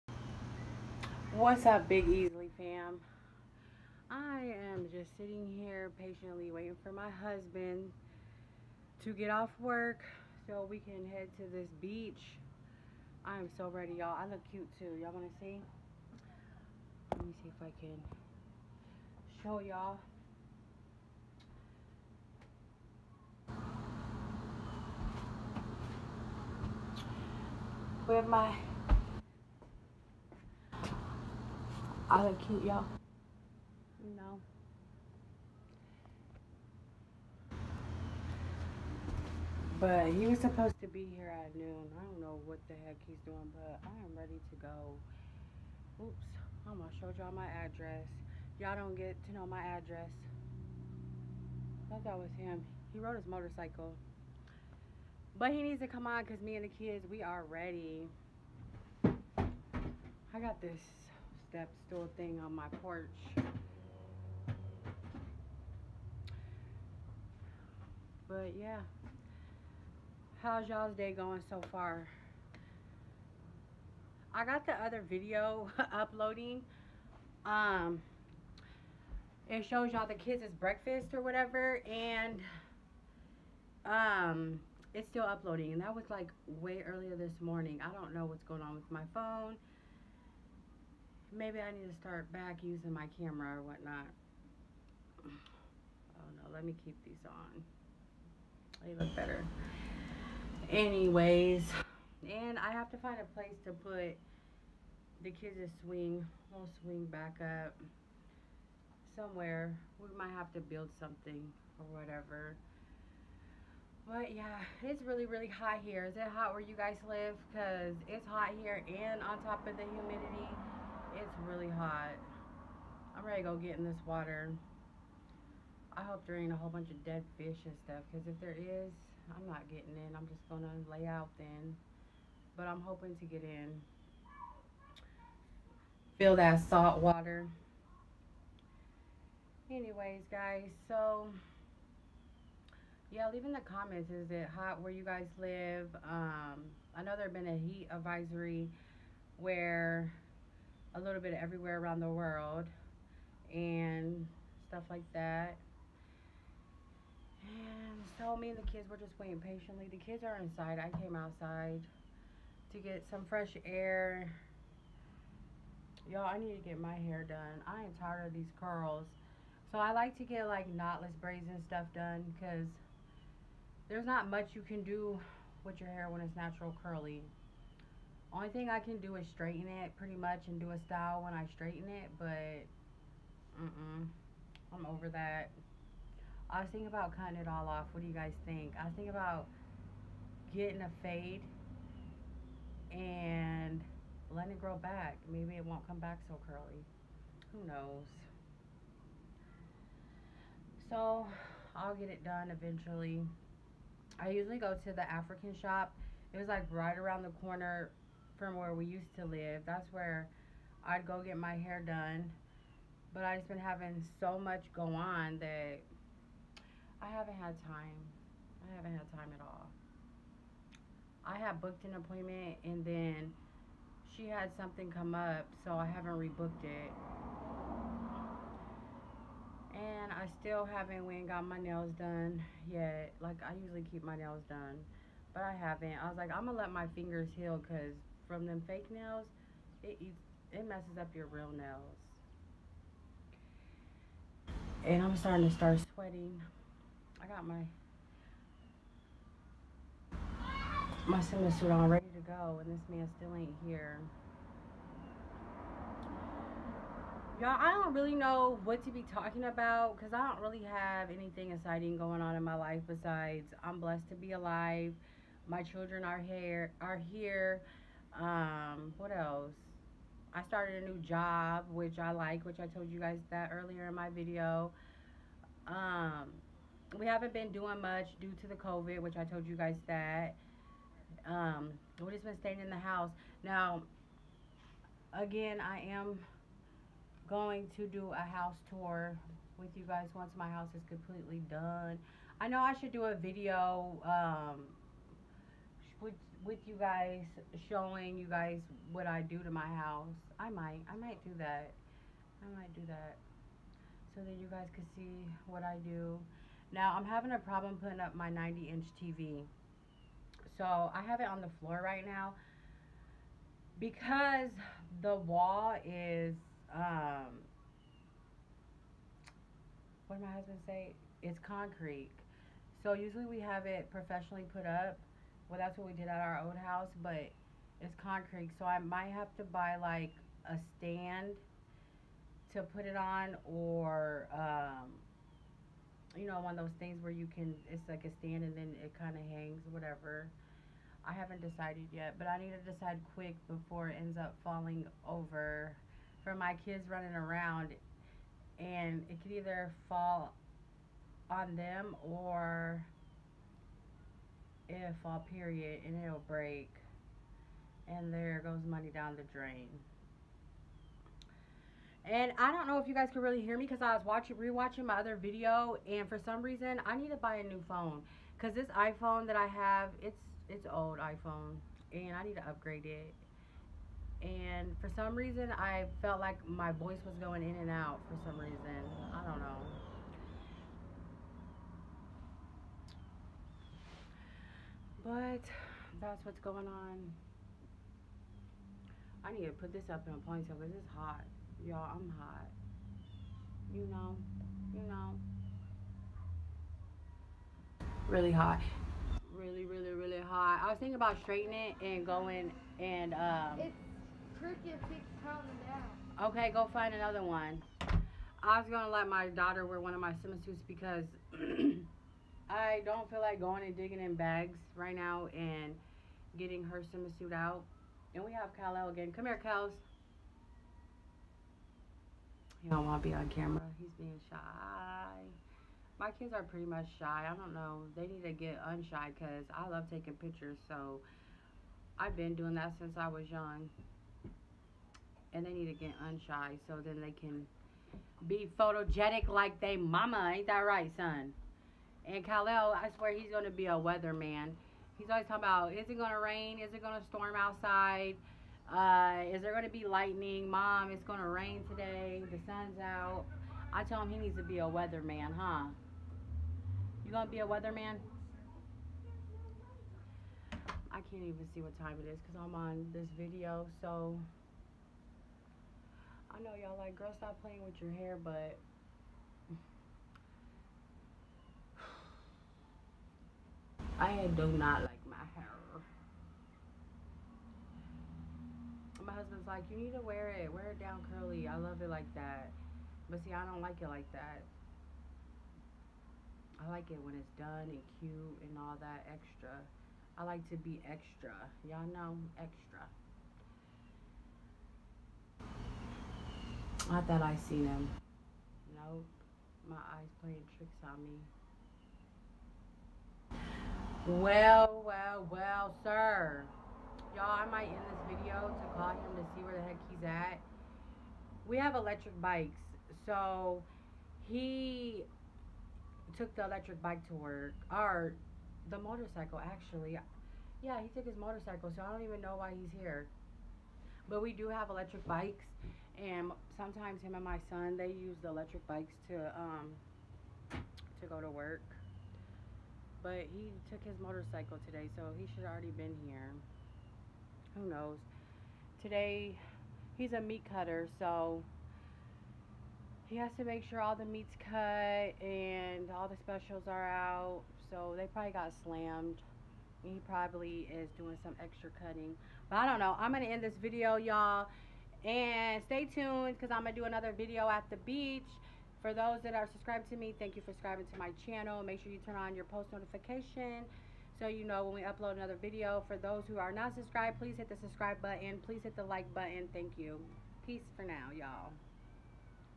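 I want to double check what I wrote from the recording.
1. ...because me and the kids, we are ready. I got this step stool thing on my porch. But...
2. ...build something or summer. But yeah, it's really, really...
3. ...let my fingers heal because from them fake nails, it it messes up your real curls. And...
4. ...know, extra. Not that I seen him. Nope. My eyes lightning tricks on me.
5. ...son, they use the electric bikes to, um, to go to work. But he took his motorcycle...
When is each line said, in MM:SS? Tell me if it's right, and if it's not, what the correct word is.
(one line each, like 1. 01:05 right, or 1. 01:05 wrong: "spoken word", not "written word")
1. 00:56 right
2. 01:50 wrong: "whatever", not "summer"
3. 03:56 wrong: "nails", not "curls"
4. 08:11 wrong: "playing", not "lightning"
5. 08:47 right.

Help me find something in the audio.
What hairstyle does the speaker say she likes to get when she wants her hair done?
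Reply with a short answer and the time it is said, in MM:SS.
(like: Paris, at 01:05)
knotless braids, at 02:50.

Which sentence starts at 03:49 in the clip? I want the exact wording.
And I still haven't went and got my nails done yet.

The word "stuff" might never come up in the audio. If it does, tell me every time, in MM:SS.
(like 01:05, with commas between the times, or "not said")
02:07, 02:34, 02:51.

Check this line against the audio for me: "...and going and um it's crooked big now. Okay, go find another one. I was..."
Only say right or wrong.
right.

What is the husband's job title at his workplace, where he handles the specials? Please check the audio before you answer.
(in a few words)
meat cutter.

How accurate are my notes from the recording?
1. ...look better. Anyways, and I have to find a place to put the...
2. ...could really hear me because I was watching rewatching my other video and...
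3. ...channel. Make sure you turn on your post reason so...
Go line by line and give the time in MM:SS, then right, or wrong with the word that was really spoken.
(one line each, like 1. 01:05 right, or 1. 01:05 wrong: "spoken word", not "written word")
1. 01:39 right
2. 06:03 right
3. 09:21 wrong: "notification", not "reason".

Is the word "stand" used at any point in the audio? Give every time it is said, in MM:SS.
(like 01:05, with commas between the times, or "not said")
05:30, 05:38.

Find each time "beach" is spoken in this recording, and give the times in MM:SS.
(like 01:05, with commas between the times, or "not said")
00:11, 09:17.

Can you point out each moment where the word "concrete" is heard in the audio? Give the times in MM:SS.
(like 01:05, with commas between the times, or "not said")
05:21, 05:28.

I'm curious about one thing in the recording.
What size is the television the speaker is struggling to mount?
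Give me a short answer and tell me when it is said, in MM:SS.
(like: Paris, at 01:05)
90-inch, at 05:08.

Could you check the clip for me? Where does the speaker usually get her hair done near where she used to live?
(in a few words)
the African shop.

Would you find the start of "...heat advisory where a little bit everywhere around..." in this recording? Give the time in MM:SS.
02:27.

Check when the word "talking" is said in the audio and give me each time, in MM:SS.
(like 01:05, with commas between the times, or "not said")
04:19, 07:25.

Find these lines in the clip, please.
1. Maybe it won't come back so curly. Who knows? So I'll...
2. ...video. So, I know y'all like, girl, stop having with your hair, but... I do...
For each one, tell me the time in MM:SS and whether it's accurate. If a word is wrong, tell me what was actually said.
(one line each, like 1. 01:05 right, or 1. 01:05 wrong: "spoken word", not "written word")
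1. 03:15 right
2. 07:43 wrong: "playing", not "having".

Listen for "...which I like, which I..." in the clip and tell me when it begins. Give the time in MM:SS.
04:31.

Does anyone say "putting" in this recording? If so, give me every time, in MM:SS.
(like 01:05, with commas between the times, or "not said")
05:07.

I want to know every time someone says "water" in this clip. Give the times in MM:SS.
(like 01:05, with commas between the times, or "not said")
02:04, 02:17.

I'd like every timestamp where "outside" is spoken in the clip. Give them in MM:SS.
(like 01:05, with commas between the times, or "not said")
02:41, 07:27.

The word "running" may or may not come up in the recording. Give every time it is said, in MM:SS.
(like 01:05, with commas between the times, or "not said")
05:46.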